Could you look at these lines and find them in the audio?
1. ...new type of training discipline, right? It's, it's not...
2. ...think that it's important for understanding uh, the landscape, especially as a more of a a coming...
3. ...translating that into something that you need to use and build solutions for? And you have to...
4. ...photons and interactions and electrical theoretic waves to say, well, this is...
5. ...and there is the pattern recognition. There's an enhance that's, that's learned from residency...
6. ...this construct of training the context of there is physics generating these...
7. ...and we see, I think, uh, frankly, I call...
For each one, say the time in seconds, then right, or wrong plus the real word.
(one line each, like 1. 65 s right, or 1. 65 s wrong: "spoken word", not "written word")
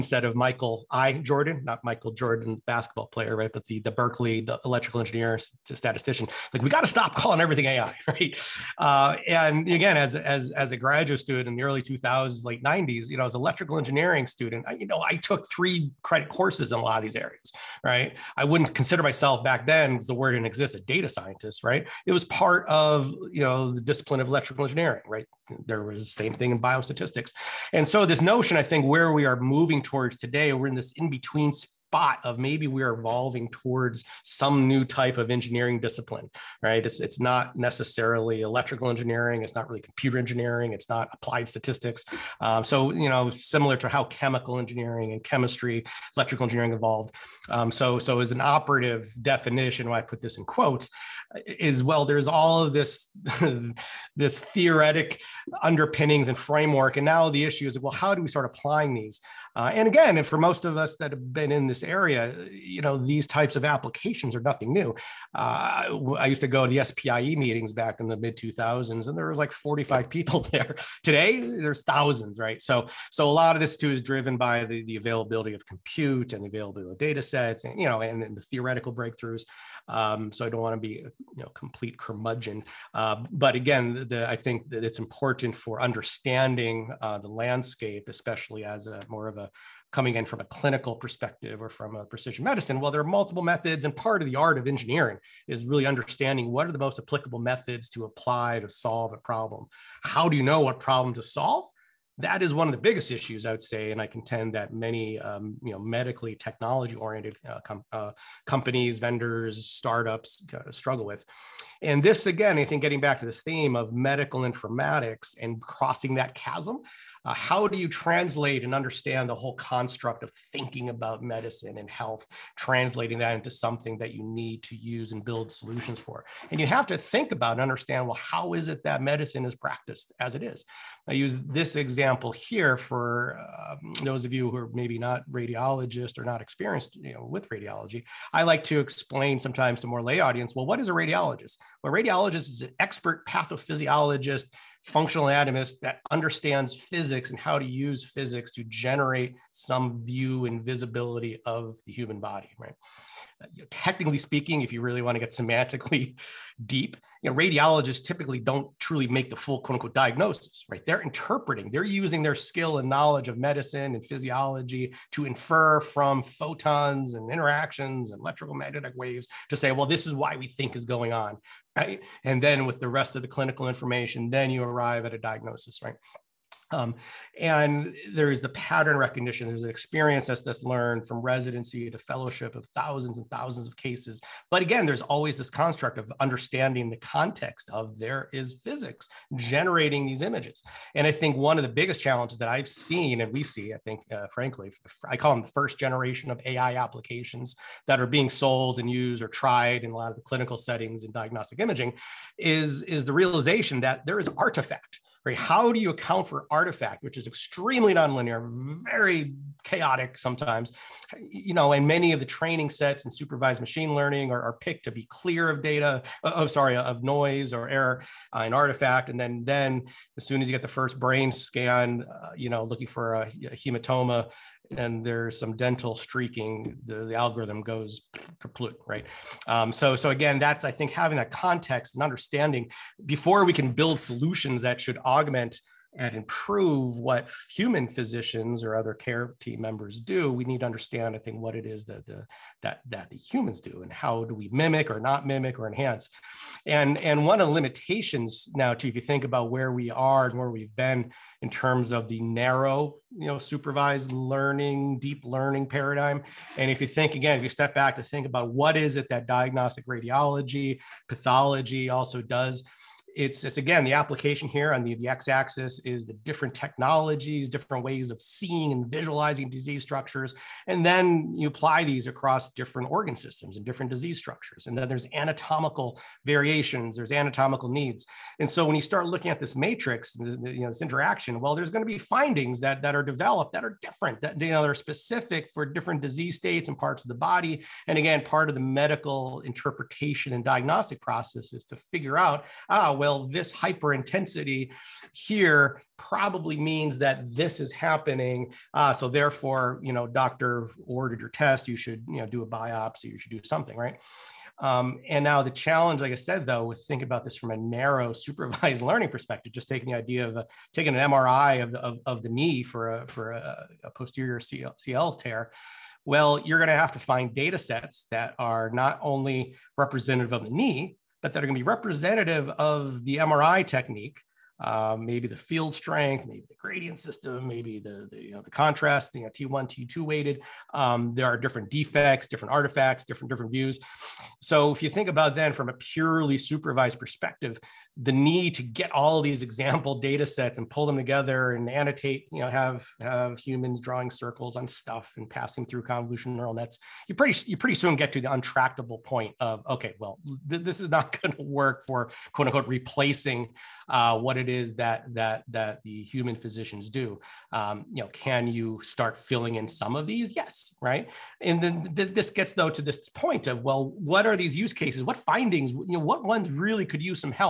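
1. 34 s wrong: "engineering", not "training"
2. 84 s right
3. 122 s right
4. 166 s wrong: "magnetic", not "theoretic"
5. 177 s wrong: "experience", not "enhance"
6. 185 s wrong: "understanding", not "training"
7. 193 s right.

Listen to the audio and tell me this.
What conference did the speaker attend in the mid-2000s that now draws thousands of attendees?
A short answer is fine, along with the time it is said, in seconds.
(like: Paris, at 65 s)
SPIE, at 66 s.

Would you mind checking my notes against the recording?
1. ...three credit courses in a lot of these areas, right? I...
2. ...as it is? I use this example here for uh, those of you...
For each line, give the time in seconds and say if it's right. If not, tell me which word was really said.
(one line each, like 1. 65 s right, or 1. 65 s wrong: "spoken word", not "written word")
1. 15 s right
2. 130 s right.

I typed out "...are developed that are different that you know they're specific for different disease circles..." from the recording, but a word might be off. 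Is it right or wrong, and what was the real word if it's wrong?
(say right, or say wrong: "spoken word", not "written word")
wrong: "states", not "circles".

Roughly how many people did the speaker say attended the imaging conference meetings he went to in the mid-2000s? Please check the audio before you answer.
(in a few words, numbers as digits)
45.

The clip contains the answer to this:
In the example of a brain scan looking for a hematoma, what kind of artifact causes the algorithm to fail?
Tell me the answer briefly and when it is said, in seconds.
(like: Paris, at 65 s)
dental streaking, at 225 s.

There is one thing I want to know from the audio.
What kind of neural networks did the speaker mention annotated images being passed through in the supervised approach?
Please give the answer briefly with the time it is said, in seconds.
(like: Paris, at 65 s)
convolutional neural nets, at 345 s.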